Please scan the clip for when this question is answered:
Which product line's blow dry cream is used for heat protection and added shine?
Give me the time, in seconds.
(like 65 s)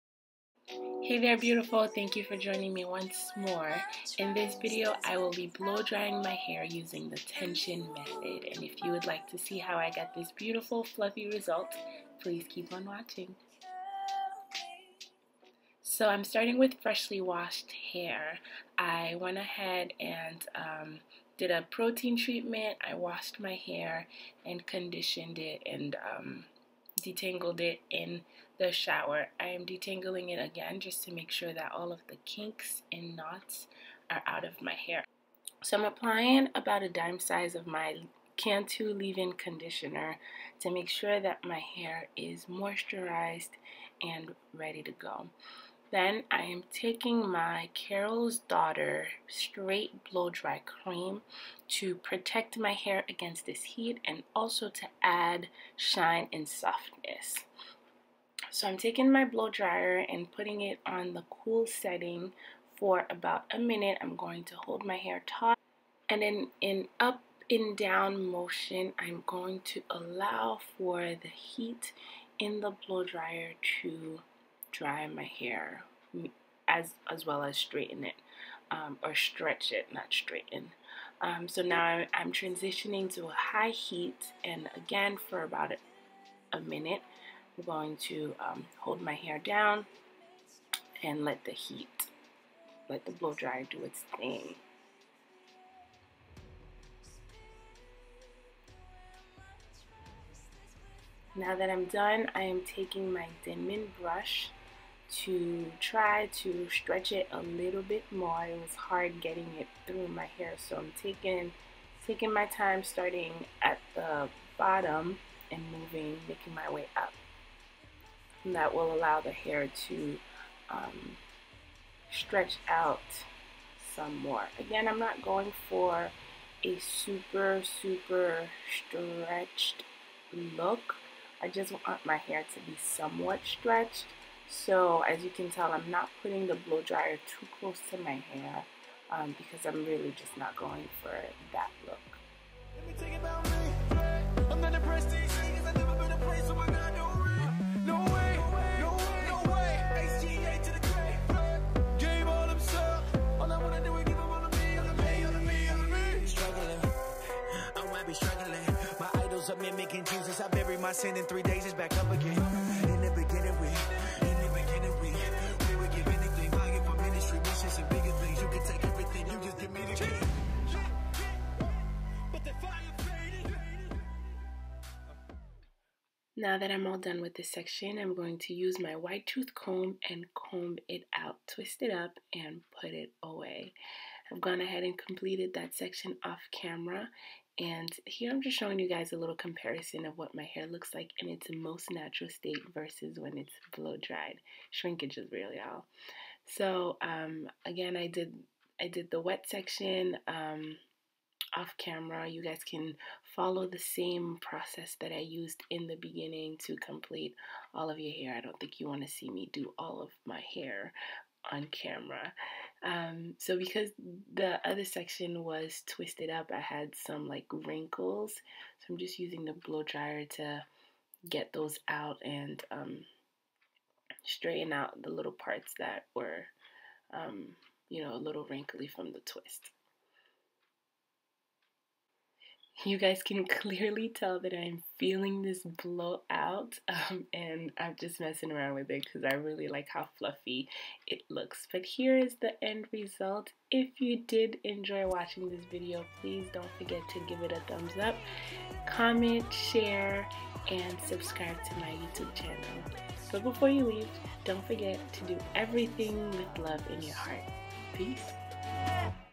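47 s.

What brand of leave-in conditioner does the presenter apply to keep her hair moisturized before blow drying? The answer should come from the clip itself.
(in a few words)
Cantu.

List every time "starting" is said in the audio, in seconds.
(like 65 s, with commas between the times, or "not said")
16 s, 112 s.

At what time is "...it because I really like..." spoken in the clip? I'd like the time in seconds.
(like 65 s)
238 s.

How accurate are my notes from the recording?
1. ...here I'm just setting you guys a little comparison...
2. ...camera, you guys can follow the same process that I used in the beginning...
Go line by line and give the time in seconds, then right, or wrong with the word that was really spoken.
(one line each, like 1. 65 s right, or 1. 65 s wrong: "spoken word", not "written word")
1. 188 s wrong: "showing", not "setting"
2. 201 s right.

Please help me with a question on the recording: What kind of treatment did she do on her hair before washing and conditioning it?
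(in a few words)
protein treatment.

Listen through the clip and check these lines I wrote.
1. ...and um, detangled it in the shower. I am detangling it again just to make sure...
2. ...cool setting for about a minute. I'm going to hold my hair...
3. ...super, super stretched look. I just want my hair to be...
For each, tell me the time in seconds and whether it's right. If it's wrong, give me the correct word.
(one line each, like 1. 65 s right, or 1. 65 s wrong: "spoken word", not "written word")
1. 25 s right
2. 61 s right
3. 126 s right.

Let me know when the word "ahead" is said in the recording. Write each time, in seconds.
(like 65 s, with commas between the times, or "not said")
19 s, 184 s.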